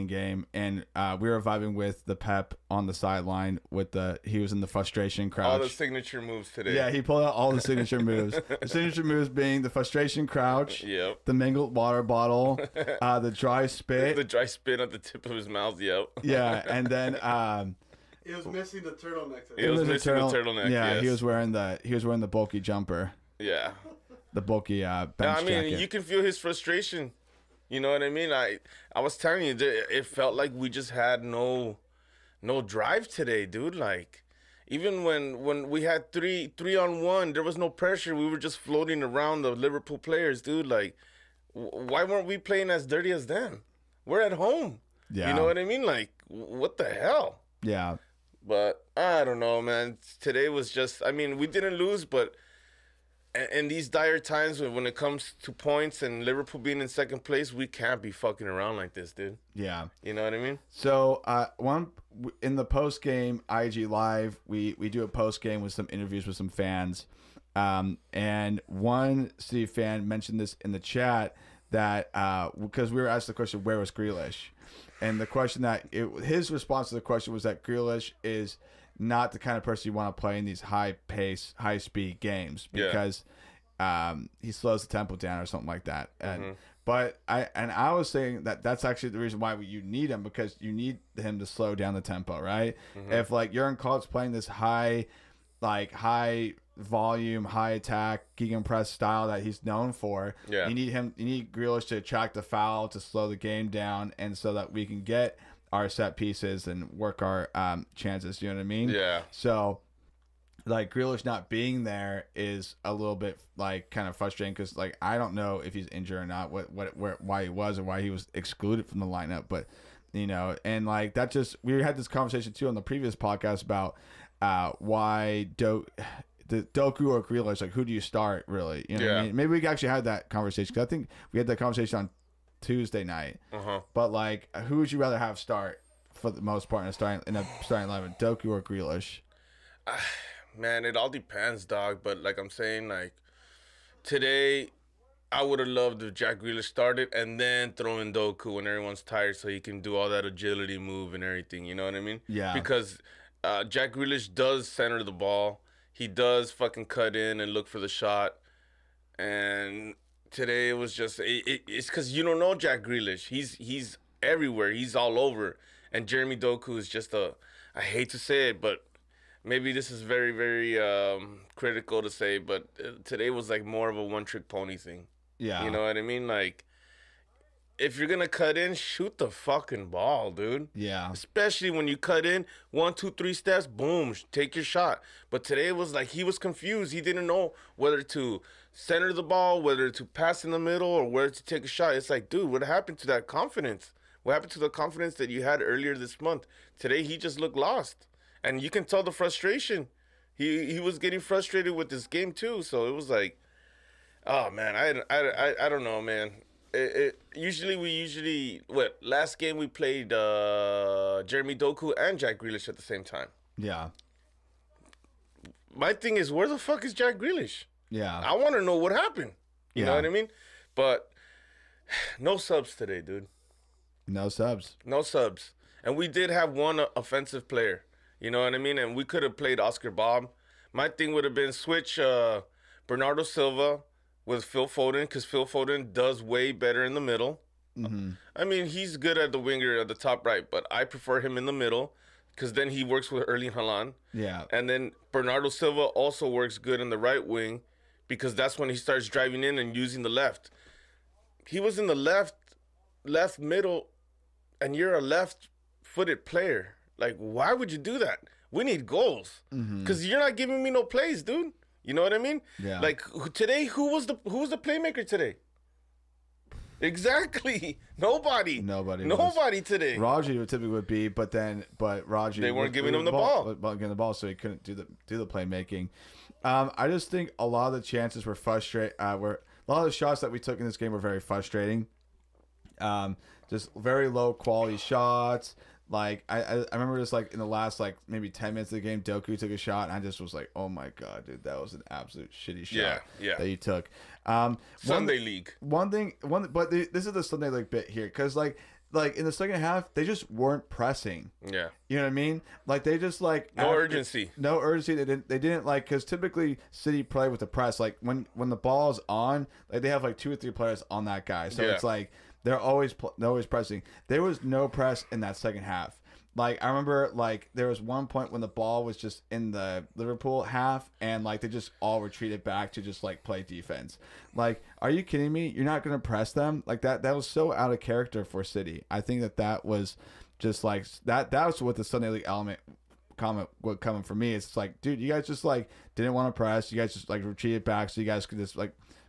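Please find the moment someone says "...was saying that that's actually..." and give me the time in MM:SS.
01:27.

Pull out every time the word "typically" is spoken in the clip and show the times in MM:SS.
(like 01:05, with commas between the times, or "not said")
04:30, 05:06.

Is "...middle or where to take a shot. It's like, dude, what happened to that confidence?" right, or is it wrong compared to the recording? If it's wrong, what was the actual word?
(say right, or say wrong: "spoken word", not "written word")
right.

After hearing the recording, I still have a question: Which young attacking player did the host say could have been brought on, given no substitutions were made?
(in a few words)
Oscar Bobb.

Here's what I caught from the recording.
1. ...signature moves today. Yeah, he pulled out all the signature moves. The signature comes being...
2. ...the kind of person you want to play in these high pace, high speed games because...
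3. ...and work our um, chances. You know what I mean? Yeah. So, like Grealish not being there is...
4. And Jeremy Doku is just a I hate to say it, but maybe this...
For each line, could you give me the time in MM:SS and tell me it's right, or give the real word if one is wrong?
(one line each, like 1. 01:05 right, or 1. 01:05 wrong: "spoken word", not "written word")
1. 00:05 wrong: "moves", not "comes"
2. 01:19 right
3. 01:46 right
4. 02:45 right.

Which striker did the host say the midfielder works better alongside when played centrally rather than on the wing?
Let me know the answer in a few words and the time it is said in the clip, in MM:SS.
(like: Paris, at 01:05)
Erling Haaland, at 04:03.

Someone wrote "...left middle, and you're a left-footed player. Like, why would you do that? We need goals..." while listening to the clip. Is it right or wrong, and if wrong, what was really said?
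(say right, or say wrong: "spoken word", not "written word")
right.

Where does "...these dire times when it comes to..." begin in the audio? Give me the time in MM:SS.
00:53.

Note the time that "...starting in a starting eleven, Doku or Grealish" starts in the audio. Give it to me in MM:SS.
02:16.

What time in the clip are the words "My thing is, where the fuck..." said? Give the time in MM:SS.
03:35.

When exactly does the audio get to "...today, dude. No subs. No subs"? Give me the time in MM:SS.
03:42.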